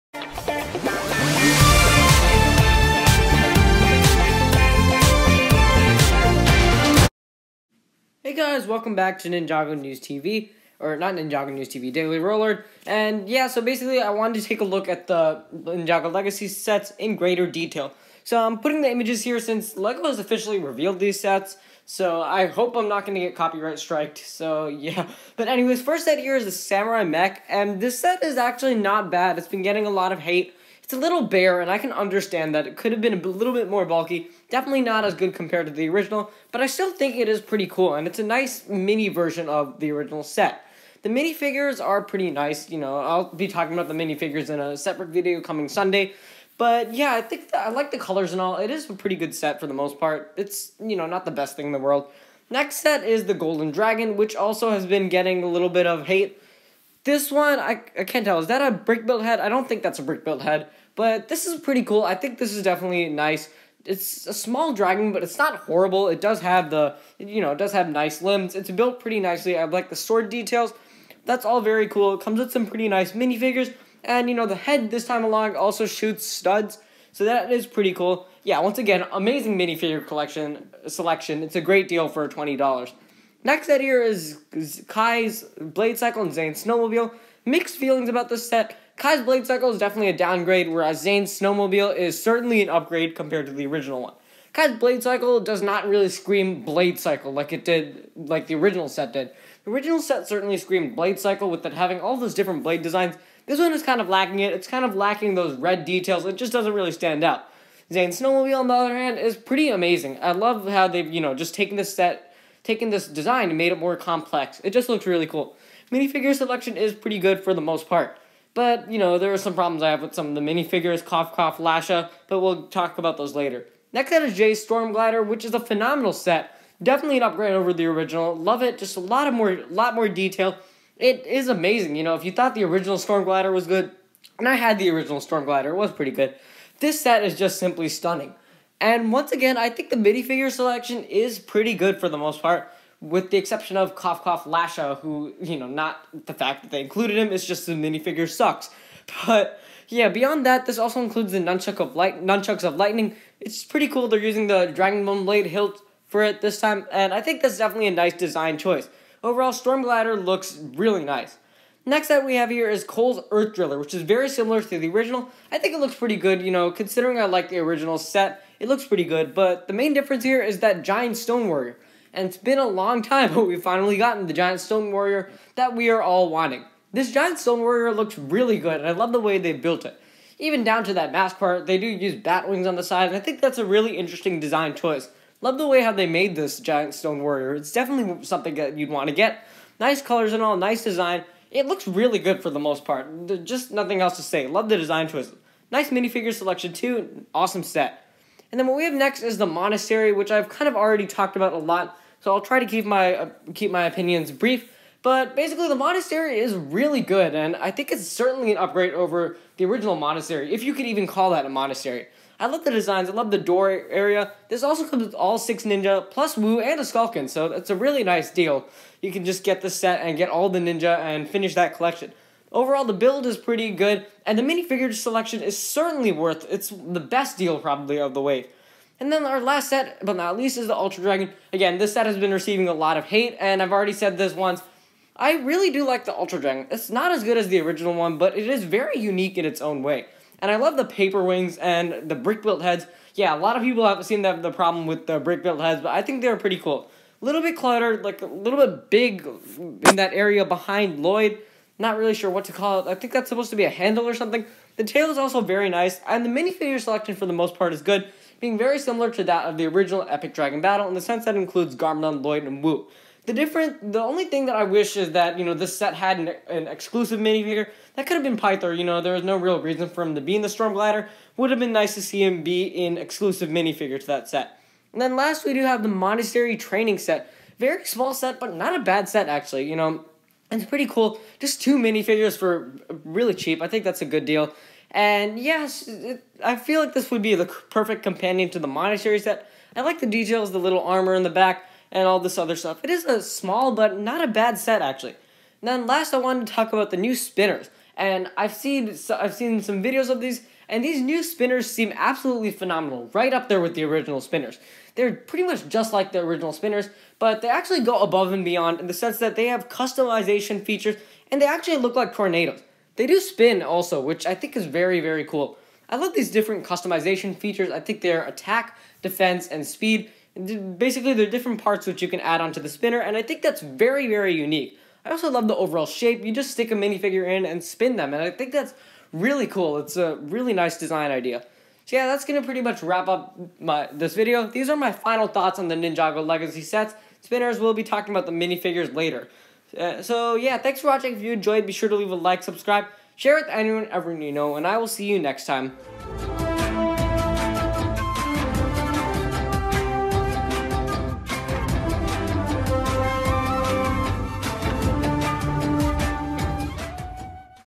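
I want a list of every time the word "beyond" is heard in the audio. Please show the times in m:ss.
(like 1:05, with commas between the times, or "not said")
2:30, 5:08.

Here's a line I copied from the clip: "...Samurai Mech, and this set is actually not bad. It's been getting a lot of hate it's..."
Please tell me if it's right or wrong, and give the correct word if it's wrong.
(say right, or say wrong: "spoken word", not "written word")
right.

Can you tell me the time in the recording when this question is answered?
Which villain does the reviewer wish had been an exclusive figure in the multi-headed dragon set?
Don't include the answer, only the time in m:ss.
4:28.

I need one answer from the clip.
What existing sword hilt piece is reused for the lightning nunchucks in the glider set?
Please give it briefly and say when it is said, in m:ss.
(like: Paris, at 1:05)
Dragon Bone Blade, at 2:34.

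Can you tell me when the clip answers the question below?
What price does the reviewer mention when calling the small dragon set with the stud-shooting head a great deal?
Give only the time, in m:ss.
1:22.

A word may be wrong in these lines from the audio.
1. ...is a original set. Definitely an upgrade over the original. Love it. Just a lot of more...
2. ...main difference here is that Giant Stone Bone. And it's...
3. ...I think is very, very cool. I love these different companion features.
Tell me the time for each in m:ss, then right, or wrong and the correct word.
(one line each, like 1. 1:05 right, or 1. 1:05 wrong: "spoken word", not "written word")
1. 2:05 wrong: "phenomenal", not "original"
2. 2:49 wrong: "Warrior", not "Bone"
3. 5:14 wrong: "customization", not "companion".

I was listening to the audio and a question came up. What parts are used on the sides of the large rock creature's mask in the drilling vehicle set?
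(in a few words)
bat wings.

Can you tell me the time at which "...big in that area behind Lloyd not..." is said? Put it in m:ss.
4:08.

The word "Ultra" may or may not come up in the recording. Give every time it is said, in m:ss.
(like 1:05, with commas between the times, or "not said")
3:50, 3:56.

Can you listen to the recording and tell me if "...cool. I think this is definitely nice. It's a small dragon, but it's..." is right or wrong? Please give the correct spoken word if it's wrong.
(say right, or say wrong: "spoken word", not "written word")
right.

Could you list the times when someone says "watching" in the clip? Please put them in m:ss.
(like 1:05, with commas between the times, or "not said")
5:40.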